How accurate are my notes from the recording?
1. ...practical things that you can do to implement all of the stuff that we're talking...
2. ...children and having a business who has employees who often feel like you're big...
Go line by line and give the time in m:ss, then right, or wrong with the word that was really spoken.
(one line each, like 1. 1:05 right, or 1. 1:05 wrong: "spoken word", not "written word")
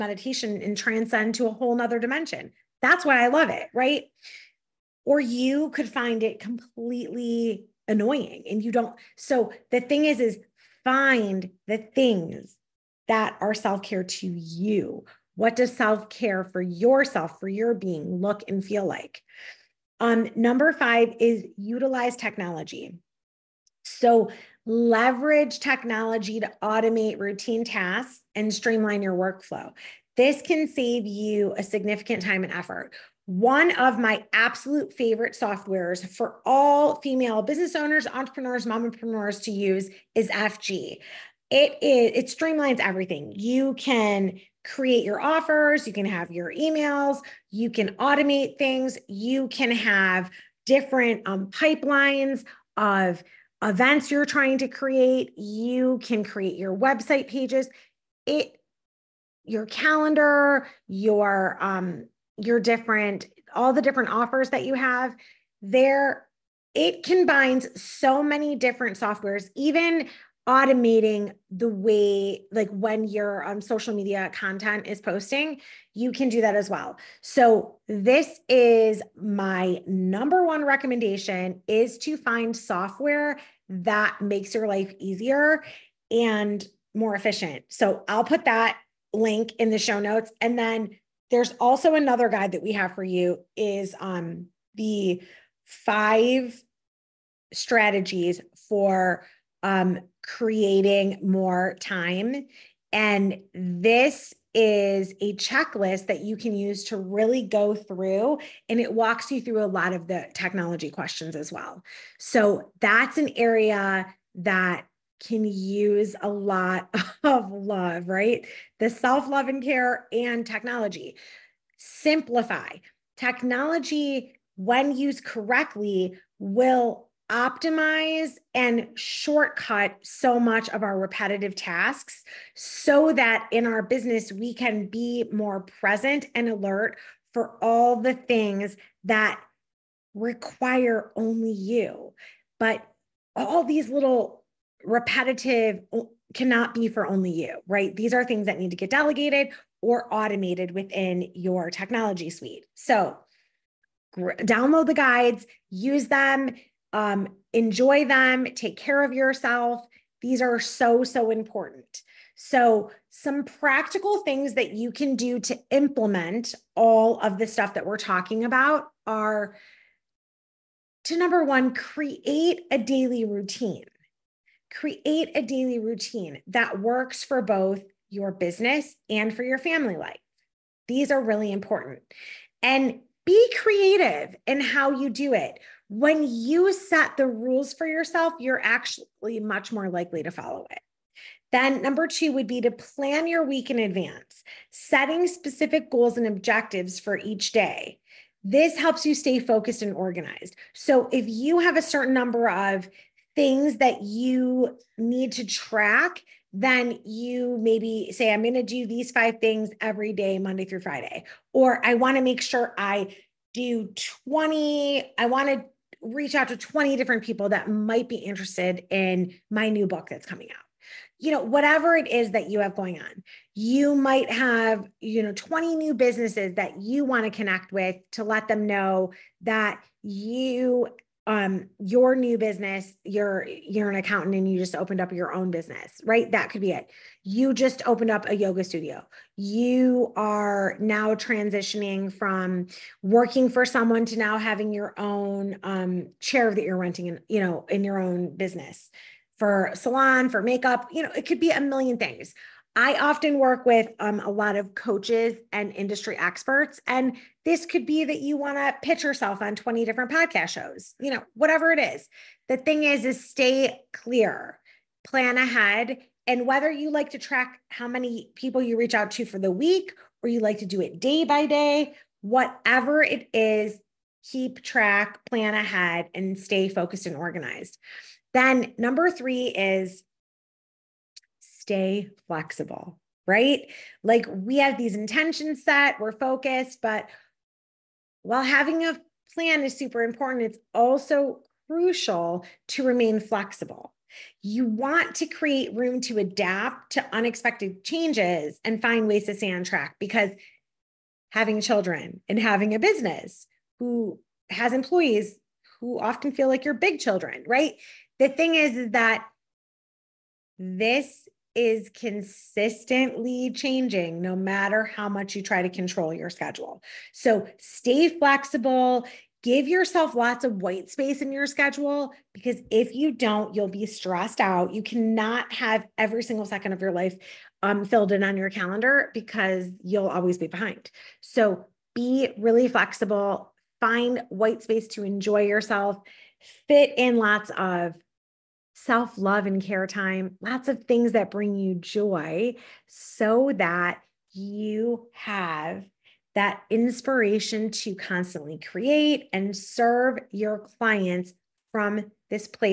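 1. 2:43 right
2. 5:01 right.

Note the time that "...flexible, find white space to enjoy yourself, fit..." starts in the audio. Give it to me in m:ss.
5:32.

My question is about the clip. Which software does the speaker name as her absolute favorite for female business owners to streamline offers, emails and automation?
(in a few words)
FG.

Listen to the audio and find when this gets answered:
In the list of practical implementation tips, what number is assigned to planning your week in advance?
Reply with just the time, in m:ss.
3:11.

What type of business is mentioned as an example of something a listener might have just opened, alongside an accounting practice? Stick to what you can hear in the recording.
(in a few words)
yoga studio.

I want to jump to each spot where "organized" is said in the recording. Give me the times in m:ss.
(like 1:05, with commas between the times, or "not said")
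3:19, 4:37.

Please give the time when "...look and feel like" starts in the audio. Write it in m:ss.
0:18.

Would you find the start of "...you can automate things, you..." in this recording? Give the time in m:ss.
0:47.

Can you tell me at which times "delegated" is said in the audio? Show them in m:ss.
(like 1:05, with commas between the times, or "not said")
2:28.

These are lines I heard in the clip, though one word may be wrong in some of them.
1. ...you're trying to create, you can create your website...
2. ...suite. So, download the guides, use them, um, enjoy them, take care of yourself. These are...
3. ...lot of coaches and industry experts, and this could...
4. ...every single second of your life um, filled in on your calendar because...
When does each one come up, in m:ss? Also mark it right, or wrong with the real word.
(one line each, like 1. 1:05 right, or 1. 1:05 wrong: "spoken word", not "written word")
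1. 0:54 right
2. 2:32 right
3. 4:14 right
4. 5:25 right.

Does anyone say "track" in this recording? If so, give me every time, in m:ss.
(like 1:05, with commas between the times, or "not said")
3:25, 4:27, 4:34, 4:59.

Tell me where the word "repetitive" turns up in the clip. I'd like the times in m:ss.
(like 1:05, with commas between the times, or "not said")
2:10, 2:24.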